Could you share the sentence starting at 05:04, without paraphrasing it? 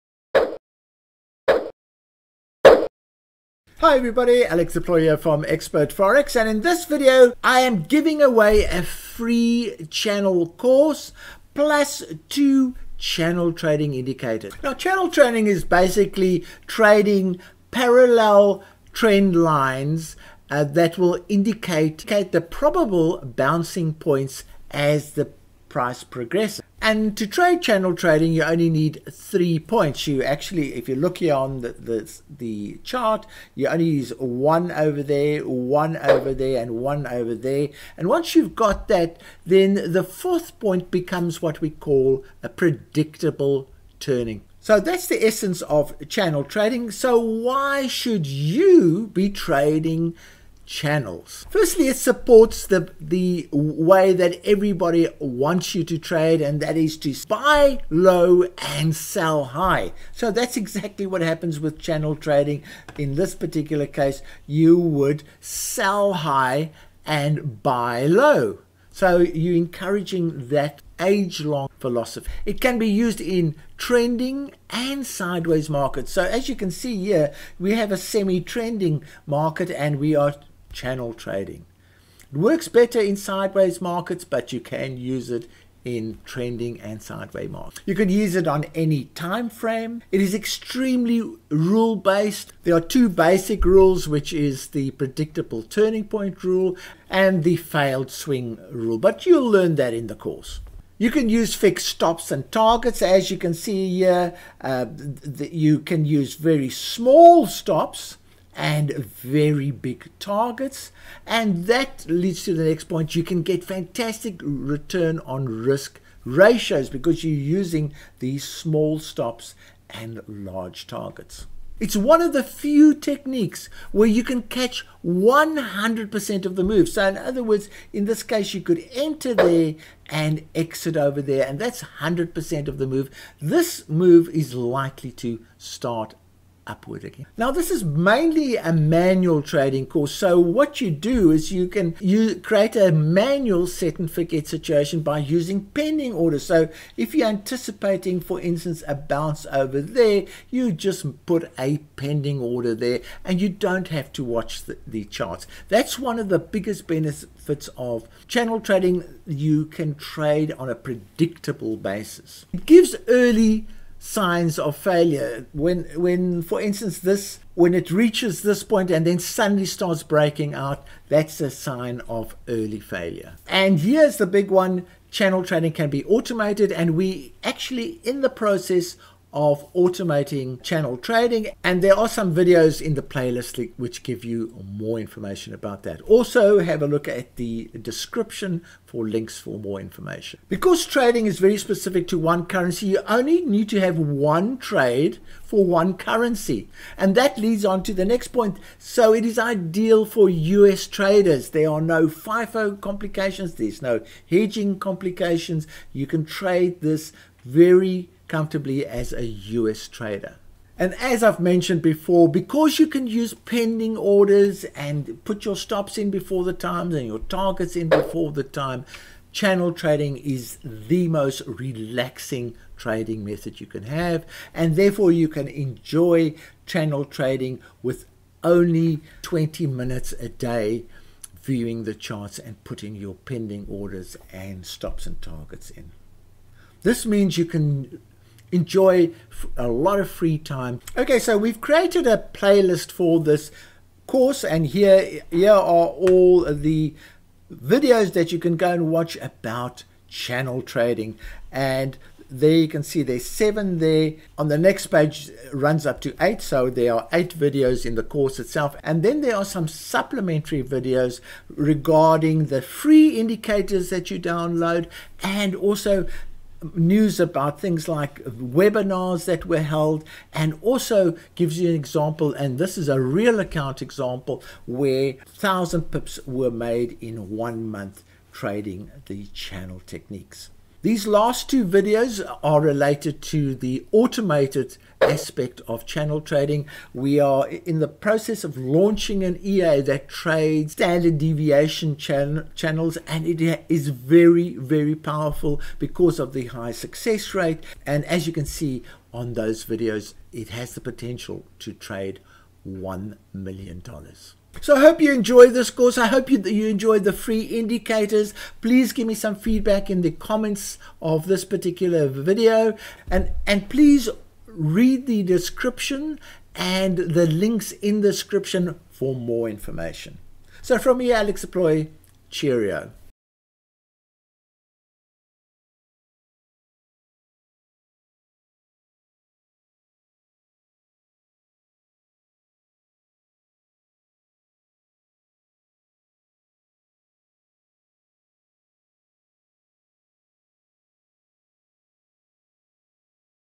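So I hope you enjoyed this course.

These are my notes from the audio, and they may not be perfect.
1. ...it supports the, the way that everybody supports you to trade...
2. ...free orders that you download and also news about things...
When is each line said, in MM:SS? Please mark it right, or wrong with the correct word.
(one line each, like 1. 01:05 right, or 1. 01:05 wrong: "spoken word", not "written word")
1. 00:51 wrong: "wants", not "supports"
2. 04:22 wrong: "indicators", not "orders".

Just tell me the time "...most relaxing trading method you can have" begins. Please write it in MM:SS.
03:41.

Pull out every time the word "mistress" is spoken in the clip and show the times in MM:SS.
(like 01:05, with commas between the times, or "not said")
not said.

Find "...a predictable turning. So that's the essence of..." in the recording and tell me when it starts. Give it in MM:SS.
00:42.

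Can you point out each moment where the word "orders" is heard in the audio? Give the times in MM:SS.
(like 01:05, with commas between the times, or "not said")
02:26, 02:32, 03:33, 03:53.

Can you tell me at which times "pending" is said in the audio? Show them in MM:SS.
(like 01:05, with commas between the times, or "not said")
02:25, 02:31, 03:33, 03:53.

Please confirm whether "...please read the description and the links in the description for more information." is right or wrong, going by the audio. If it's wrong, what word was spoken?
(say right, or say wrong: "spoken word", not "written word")
right.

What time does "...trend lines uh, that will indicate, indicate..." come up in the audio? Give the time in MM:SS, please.
00:18.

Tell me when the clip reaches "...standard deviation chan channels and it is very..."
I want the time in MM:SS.
04:50.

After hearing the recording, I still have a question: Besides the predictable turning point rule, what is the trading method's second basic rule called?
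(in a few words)
failed swing rule.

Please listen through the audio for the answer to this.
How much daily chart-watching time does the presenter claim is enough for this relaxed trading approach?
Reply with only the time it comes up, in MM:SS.
03:49.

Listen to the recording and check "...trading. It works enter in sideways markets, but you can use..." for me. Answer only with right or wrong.
wrong.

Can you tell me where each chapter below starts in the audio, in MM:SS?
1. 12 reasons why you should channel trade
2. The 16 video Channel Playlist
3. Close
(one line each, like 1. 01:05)
1. 00:15
2. 04:01
3. 05:06.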